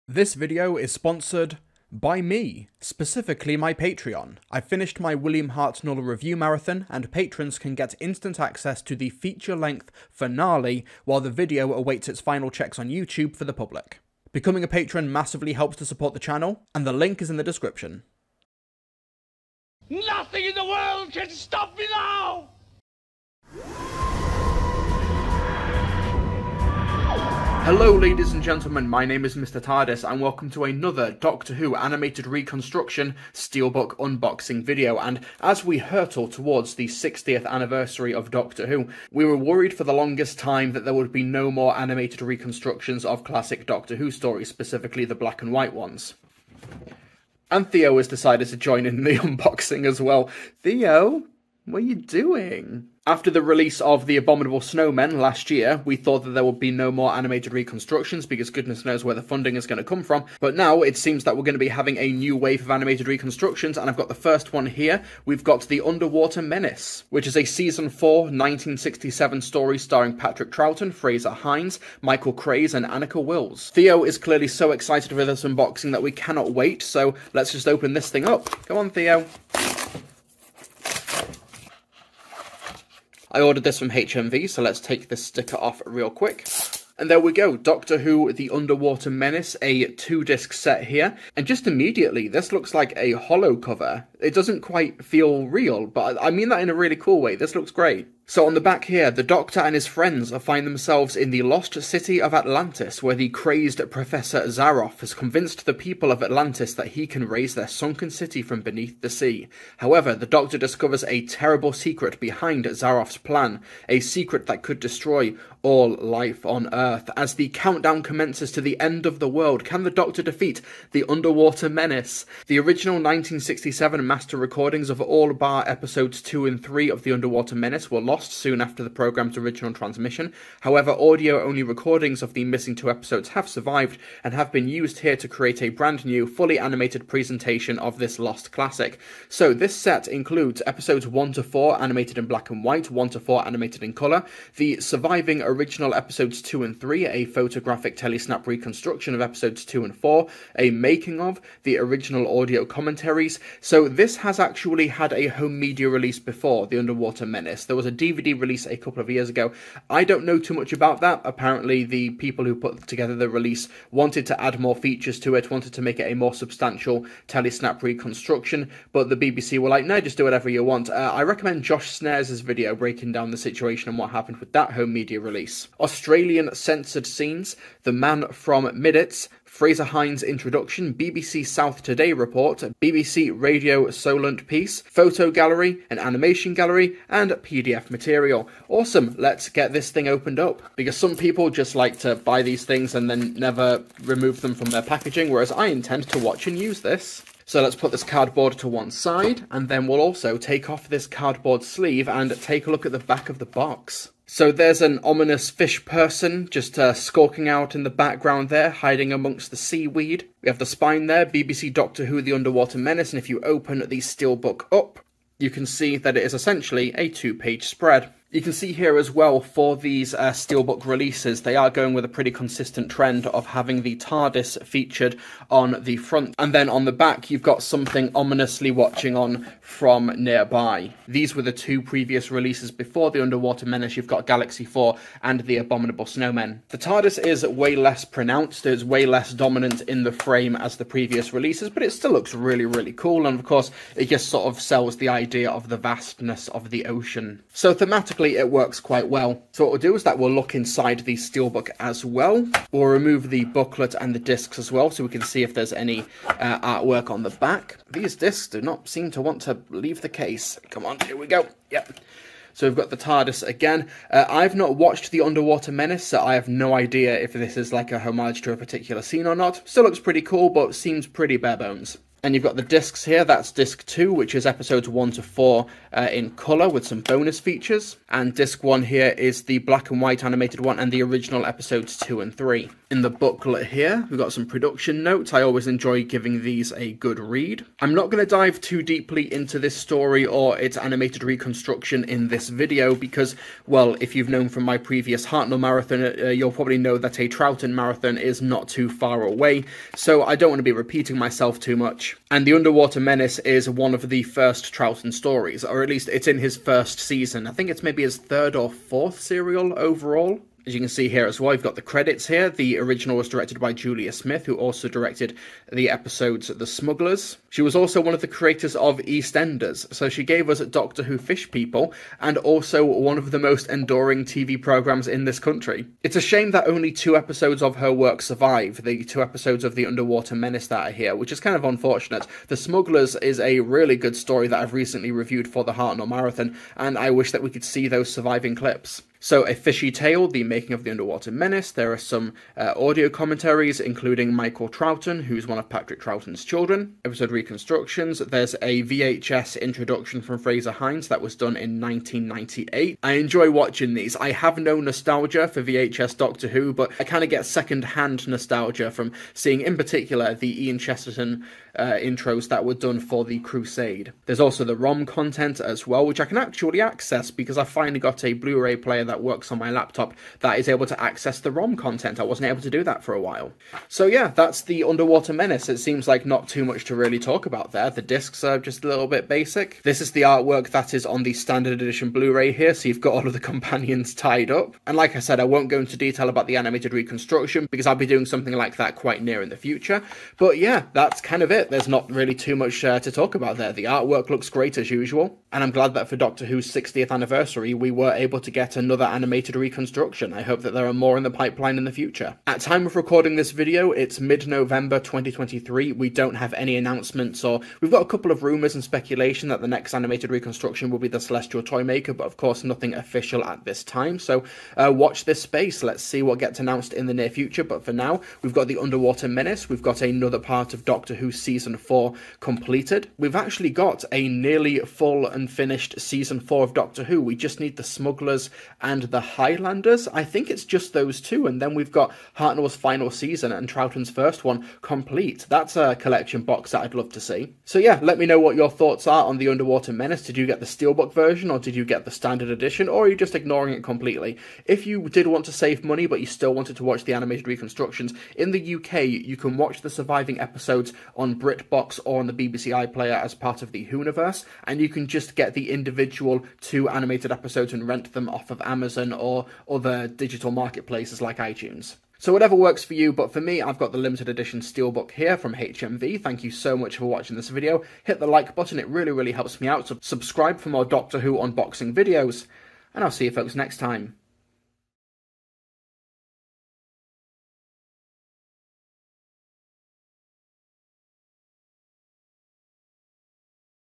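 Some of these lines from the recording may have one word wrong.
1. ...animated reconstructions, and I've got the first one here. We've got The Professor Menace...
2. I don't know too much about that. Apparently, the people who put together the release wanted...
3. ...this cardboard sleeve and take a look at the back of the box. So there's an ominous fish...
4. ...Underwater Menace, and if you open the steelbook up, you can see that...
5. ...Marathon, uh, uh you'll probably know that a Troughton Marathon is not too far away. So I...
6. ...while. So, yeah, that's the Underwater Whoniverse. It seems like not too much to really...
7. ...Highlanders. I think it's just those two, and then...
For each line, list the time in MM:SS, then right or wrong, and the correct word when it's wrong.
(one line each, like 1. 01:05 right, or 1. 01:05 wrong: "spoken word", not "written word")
1. 01:02 wrong: "Underwater", not "Professor"
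2. 02:39 right
3. 03:20 right
4. 03:32 right
5. 04:55 right
6. 06:13 wrong: "Menace", not "Whoniverse"
7. 07:09 right.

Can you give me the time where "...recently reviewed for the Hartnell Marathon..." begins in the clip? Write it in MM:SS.
05:34.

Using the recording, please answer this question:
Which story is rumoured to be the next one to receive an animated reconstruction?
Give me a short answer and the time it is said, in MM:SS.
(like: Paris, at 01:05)
The Celestial Toymaker, at 06:51.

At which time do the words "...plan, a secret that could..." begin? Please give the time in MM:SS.
01:53.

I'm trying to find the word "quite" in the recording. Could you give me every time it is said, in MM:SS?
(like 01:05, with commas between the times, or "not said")
01:34, 04:08, 06:28.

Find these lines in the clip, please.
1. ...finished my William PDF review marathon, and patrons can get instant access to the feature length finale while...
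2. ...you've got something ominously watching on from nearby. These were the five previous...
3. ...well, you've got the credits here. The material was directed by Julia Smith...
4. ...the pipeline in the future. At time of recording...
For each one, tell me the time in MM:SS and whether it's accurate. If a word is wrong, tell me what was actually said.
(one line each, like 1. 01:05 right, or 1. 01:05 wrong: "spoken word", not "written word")
1. 00:04 wrong: "Hartnell", not "PDF"
2. 03:47 wrong: "two", not "five"
3. 05:11 wrong: "original", not "material"
4. 06:41 right.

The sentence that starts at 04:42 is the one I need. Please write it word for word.
In the booklet here, we've got some production notes.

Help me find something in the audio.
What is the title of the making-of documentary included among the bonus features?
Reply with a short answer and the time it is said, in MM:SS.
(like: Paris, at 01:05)
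A Fishy Tale, at 05:39.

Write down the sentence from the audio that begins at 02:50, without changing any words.
Uh, I recommend Josh Snares' video breaking down the situation and what happened with that home media release.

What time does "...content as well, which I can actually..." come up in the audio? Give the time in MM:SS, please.
06:05.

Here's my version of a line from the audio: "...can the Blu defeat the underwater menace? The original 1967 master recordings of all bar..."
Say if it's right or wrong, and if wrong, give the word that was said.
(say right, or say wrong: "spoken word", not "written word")
wrong: "Doctor", not "Blu".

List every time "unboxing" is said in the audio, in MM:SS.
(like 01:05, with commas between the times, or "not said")
00:33, 00:49, 01:15, 07:51.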